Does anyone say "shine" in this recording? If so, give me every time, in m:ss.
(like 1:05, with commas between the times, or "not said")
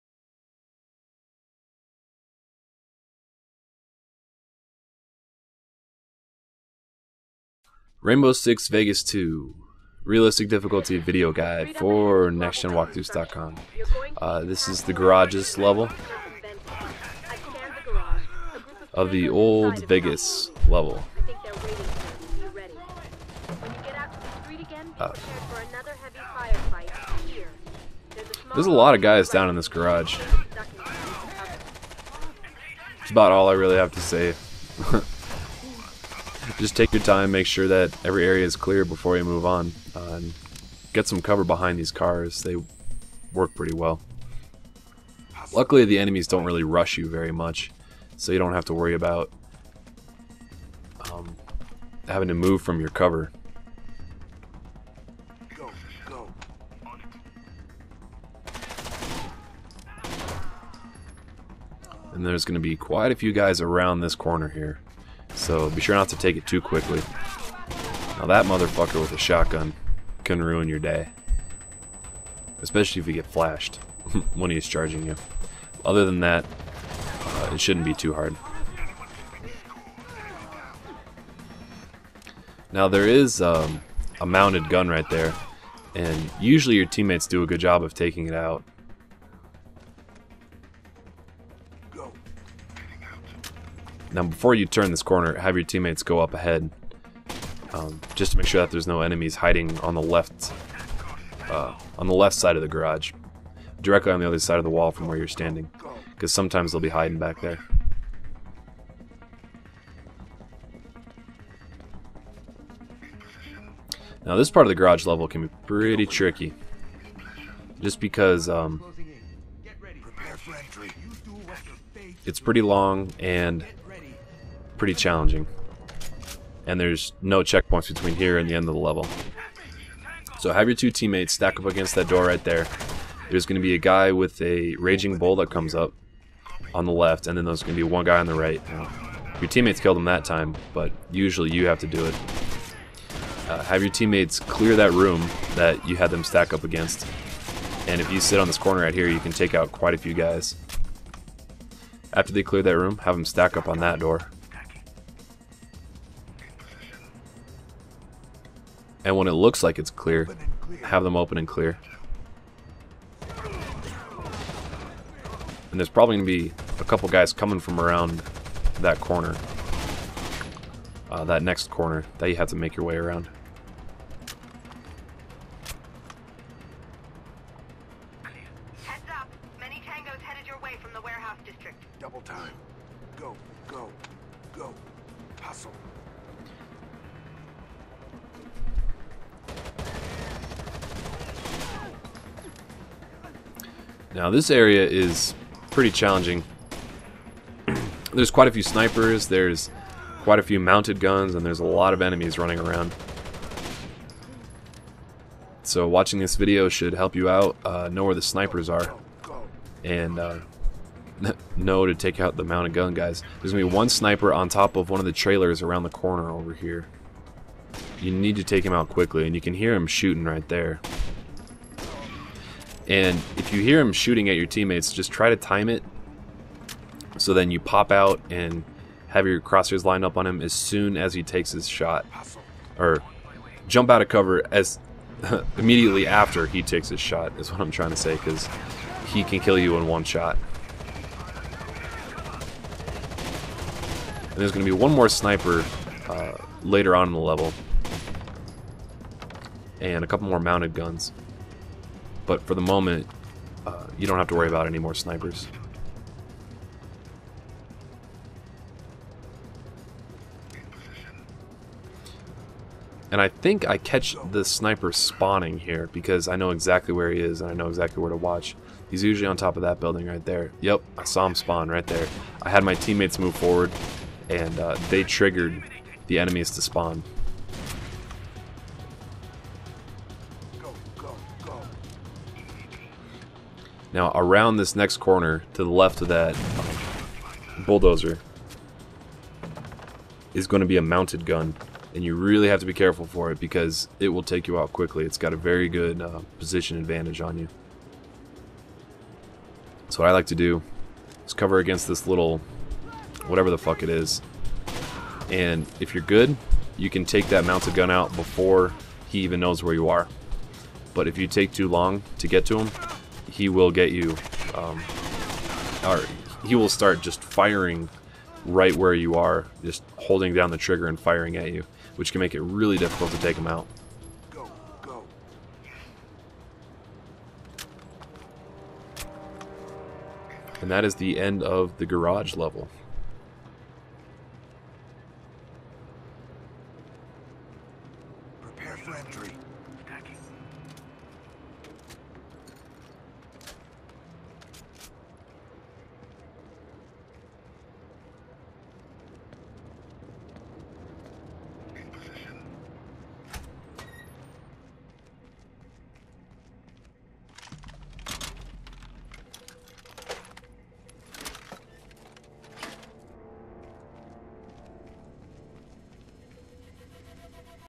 not said.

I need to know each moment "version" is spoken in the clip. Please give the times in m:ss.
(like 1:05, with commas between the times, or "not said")
not said.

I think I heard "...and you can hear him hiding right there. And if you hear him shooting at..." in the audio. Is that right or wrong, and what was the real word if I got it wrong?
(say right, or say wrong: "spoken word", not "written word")
wrong: "shooting", not "hiding".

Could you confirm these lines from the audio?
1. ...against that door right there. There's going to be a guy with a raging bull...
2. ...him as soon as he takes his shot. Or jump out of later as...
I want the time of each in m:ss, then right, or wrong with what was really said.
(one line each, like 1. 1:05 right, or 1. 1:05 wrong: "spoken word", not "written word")
1. 2:11 right
2. 3:50 wrong: "cover", not "later".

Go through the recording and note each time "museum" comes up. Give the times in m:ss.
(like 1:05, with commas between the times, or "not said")
not said.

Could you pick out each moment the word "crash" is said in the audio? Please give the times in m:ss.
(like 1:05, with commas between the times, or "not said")
not said.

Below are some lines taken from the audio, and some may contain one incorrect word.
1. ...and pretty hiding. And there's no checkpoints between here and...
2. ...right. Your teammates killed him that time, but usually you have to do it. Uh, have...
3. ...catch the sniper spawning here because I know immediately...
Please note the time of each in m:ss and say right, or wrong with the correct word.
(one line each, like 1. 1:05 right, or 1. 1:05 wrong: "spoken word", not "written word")
1. 2:03 wrong: "challenging", not "hiding"
2. 2:18 right
3. 4:23 wrong: "exactly", not "immediately".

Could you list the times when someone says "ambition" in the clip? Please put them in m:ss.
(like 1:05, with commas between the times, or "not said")
not said.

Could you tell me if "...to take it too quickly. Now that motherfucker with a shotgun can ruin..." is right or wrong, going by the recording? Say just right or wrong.
right.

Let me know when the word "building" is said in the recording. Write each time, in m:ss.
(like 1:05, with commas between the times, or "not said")
4:29.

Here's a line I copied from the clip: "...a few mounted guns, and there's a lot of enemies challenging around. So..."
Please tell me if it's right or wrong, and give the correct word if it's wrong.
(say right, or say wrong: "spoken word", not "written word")
wrong: "running", not "challenging".